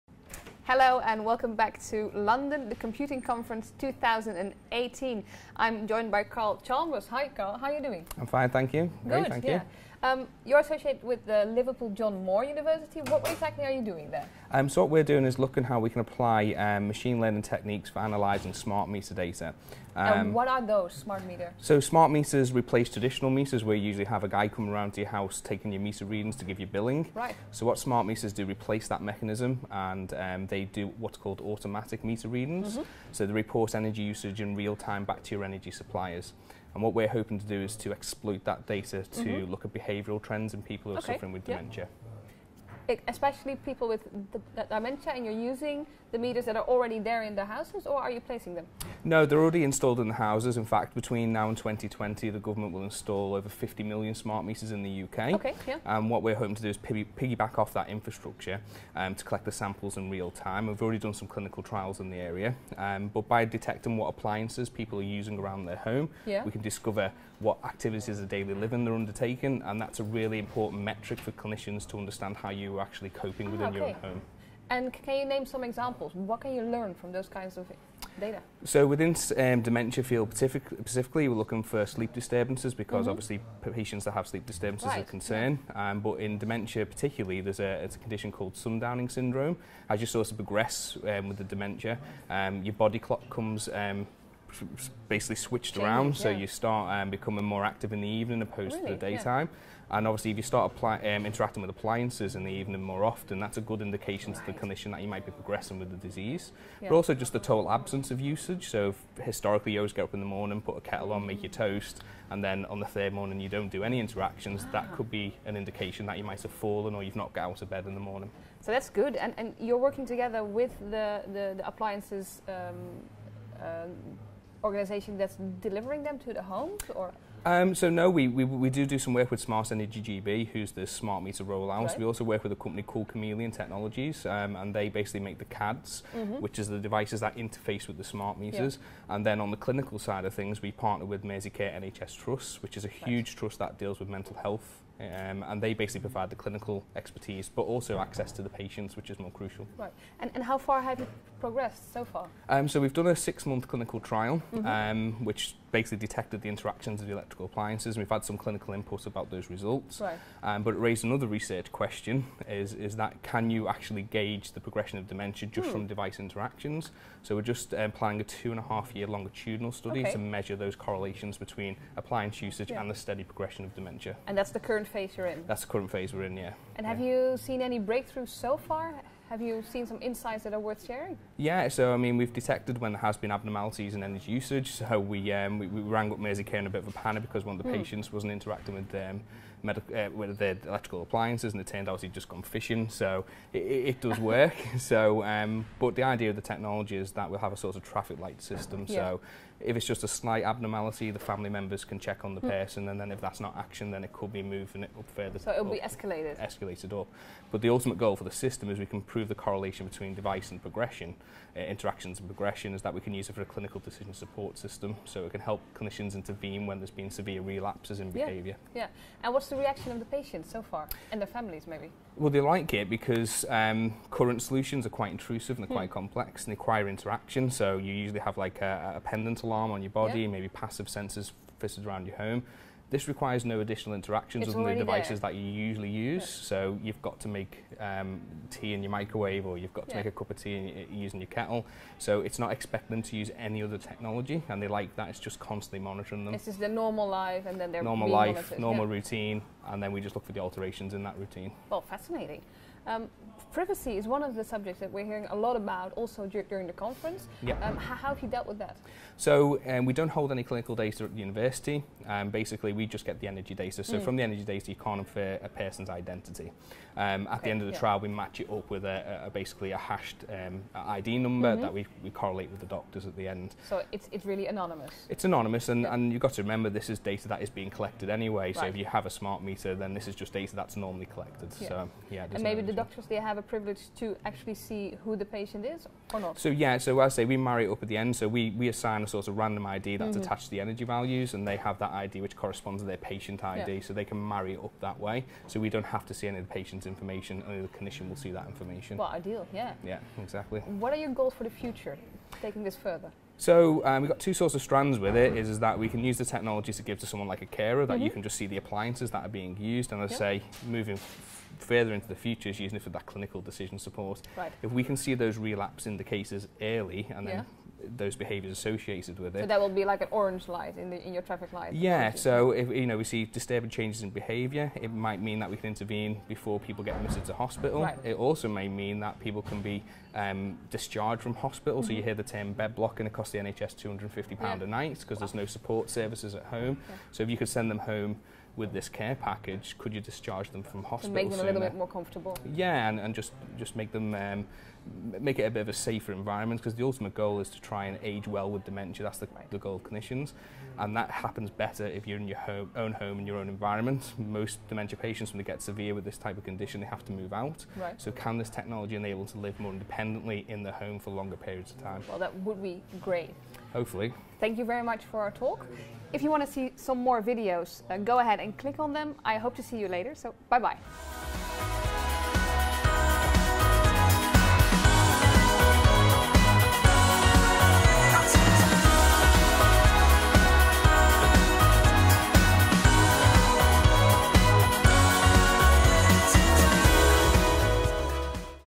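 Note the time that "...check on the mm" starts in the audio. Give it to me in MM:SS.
03:21.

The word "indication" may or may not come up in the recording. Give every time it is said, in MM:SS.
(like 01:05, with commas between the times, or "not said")
01:43, 01:55.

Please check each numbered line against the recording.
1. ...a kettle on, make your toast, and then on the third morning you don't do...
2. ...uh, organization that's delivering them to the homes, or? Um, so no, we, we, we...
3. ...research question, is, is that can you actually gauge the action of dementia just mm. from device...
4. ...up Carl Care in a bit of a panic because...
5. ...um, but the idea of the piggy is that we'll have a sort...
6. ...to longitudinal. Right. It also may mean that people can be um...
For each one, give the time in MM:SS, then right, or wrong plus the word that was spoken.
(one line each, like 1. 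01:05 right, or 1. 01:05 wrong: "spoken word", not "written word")
1. 01:50 right
2. 02:03 right
3. 02:41 wrong: "progression", not "action"
4. 03:06 wrong: "Mersey", not "Carl"
5. 03:15 wrong: "technology", not "piggy"
6. 05:27 wrong: "hospital", not "longitudinal".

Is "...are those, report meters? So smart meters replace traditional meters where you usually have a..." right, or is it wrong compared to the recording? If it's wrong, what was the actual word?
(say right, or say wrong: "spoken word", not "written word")
wrong: "smart", not "report".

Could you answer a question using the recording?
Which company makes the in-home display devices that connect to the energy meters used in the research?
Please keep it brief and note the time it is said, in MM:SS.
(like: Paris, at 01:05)
Chameleon Technologies, at 02:13.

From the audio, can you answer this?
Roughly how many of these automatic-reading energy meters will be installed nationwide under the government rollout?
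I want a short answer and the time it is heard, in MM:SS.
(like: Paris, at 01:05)
50 million, at 00:53.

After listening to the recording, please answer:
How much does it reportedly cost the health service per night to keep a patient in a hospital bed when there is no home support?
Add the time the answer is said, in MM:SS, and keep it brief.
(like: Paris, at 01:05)
250 pounds, at 05:33.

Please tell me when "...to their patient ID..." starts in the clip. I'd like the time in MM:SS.
04:52.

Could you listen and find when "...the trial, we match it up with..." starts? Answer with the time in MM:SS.
04:27.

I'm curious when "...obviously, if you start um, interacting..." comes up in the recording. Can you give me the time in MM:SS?
01:40.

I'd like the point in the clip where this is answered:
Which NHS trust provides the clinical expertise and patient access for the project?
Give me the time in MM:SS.
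02:21.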